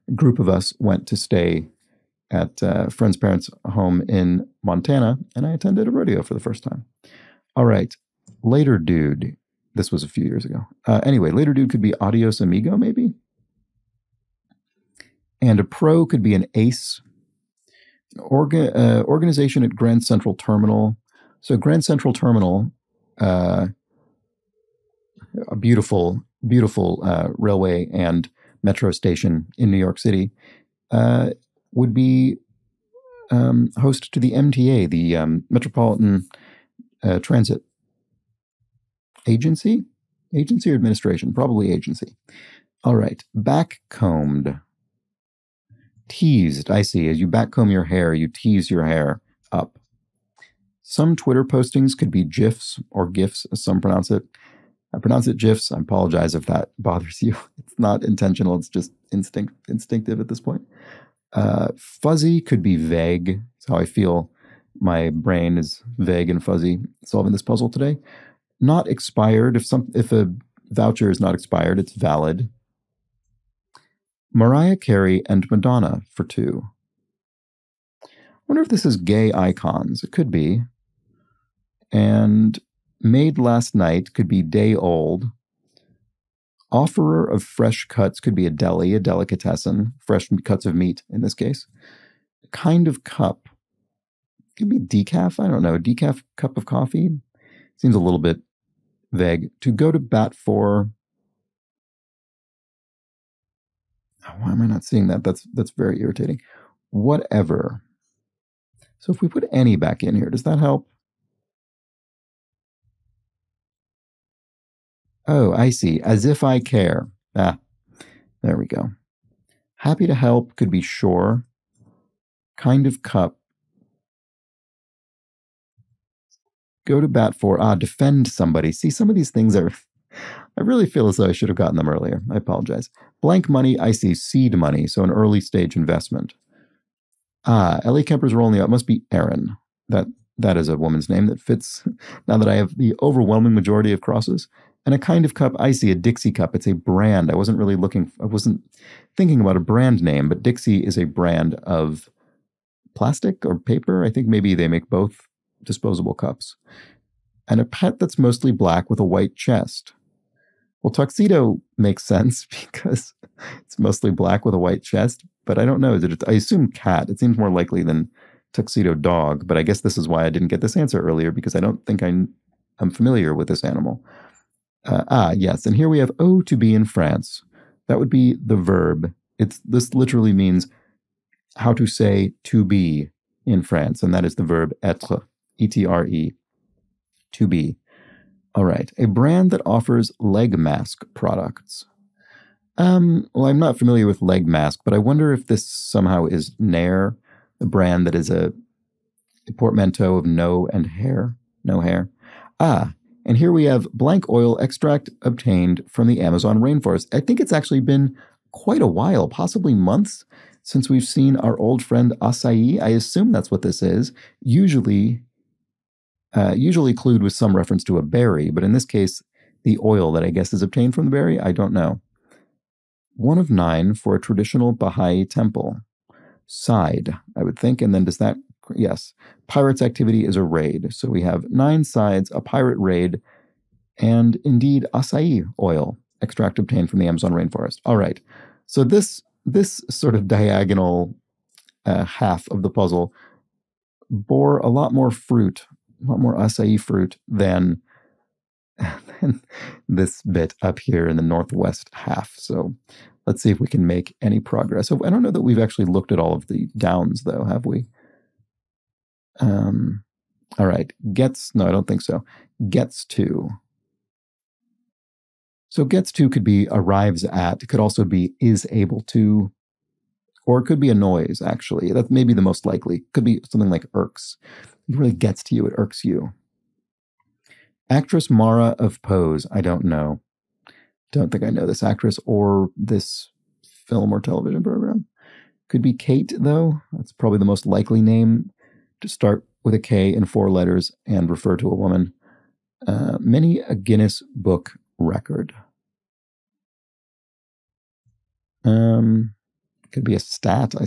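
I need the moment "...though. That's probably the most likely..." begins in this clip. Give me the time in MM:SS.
04:46.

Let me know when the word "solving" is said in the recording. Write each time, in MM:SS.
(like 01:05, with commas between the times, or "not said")
01:07.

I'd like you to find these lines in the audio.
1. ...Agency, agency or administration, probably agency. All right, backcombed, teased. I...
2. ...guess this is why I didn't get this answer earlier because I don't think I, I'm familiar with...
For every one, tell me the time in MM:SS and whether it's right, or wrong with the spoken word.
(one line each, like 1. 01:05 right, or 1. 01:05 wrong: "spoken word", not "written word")
1. 00:39 right
2. 02:49 right.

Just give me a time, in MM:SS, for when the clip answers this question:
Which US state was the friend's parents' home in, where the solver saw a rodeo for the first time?
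00:04.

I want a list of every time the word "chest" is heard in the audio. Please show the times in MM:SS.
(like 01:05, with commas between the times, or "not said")
02:39, 02:44.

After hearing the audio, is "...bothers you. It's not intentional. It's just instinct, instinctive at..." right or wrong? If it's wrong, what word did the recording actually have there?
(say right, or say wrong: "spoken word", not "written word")
right.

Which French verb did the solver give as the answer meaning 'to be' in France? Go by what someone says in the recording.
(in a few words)
être.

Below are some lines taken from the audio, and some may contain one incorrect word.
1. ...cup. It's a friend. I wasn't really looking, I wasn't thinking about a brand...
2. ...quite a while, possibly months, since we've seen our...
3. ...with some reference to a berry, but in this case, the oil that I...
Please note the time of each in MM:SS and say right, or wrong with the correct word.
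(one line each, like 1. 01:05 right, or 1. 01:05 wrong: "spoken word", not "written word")
1. 02:26 wrong: "brand", not "friend"
2. 03:28 right
3. 03:37 right.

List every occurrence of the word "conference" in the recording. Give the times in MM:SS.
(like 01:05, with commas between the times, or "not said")
not said.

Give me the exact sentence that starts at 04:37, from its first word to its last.
Actress Mara of Pose, I don't know.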